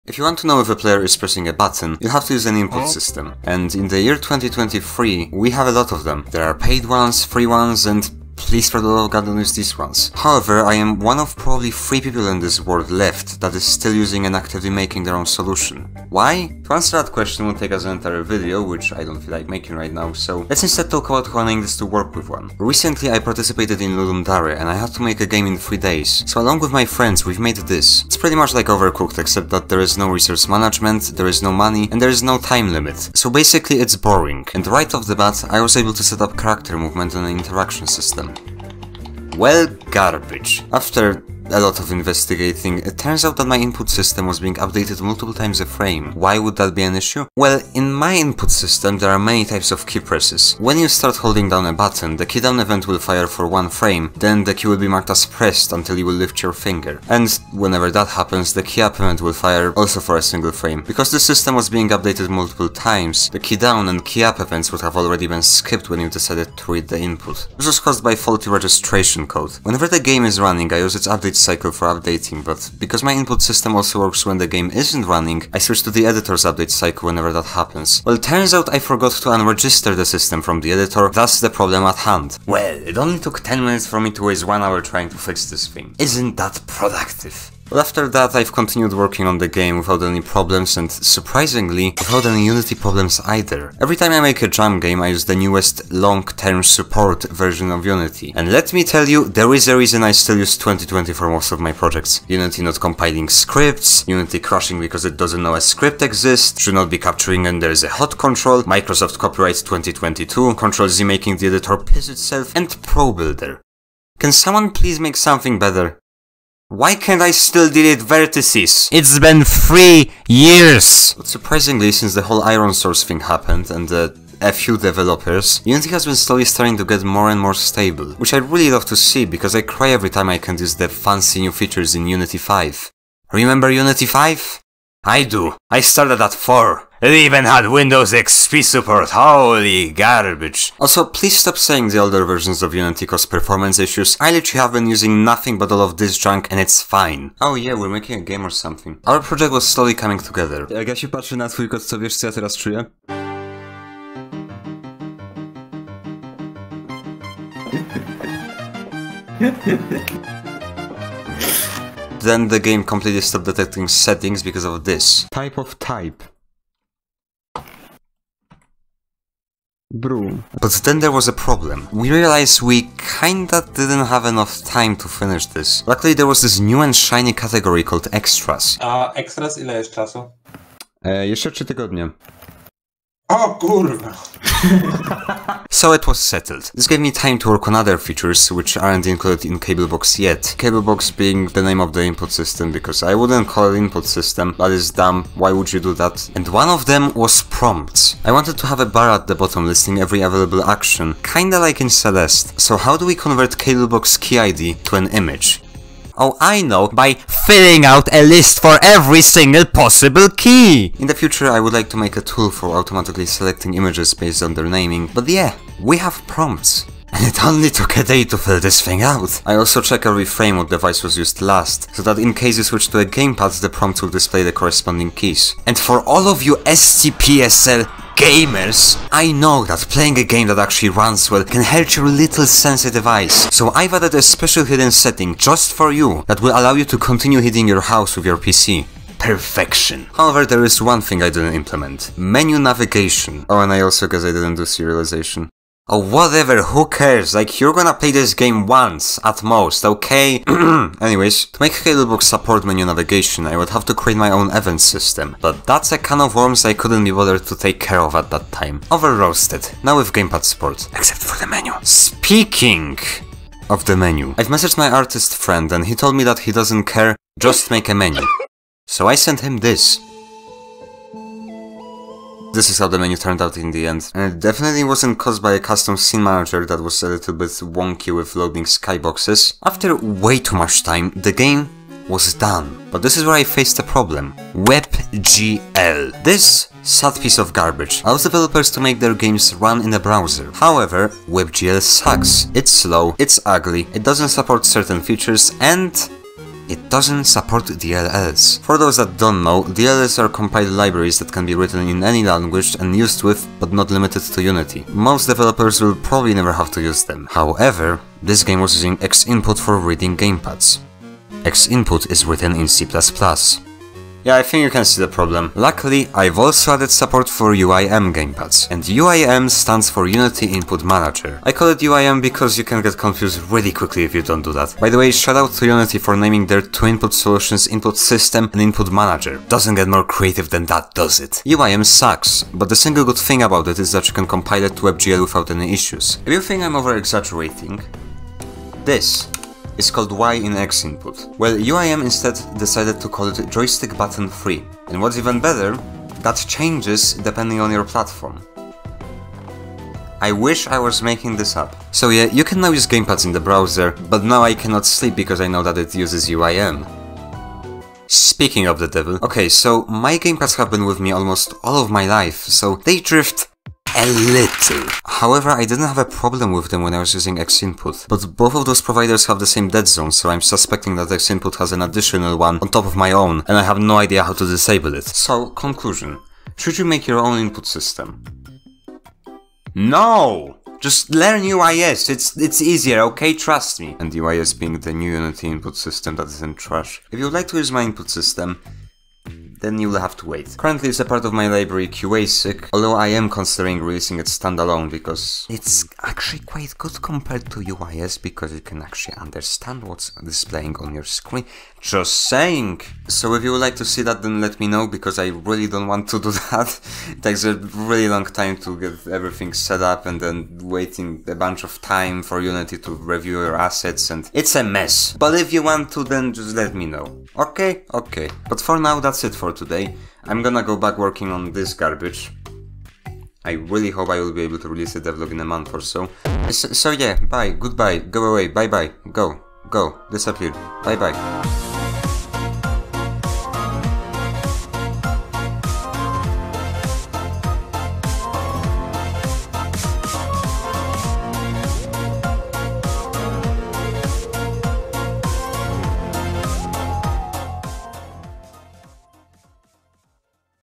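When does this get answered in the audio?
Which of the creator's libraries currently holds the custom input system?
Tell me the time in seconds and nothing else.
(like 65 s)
391 s.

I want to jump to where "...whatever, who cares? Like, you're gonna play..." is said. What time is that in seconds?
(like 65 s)
245 s.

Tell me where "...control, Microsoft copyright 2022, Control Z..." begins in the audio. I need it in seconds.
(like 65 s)
108 s.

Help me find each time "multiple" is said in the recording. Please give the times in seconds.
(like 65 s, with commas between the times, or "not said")
45 s, 62 s.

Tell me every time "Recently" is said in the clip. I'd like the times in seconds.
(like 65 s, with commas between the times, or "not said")
22 s.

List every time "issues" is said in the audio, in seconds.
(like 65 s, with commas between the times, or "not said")
46 s, 143 s, 335 s.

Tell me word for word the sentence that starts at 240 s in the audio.
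However, there is one thing I didn't implement.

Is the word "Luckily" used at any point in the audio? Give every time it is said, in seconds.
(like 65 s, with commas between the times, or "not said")
175 s, 315 s.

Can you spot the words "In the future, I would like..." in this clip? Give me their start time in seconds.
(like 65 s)
210 s.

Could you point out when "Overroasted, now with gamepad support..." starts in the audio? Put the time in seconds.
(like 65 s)
258 s.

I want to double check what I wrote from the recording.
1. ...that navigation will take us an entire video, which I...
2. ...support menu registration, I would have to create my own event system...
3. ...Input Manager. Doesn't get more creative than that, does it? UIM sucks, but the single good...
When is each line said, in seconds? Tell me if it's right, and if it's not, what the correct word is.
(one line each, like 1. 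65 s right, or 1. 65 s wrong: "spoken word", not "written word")
1. 17 s wrong: "question", not "navigation"
2. 252 s wrong: "navigation", not "registration"
3. 328 s right.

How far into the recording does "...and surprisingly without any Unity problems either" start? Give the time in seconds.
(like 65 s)
90 s.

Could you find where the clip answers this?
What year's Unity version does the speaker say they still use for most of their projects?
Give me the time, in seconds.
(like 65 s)
100 s.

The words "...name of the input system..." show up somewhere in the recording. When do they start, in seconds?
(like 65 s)
191 s.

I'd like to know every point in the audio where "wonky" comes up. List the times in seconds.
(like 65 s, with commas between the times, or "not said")
277 s.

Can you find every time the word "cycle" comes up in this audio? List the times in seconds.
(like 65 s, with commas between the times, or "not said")
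71 s, 76 s.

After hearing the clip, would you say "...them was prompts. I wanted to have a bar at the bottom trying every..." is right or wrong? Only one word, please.
wrong.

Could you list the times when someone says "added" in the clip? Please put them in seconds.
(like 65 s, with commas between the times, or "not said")
233 s, 316 s.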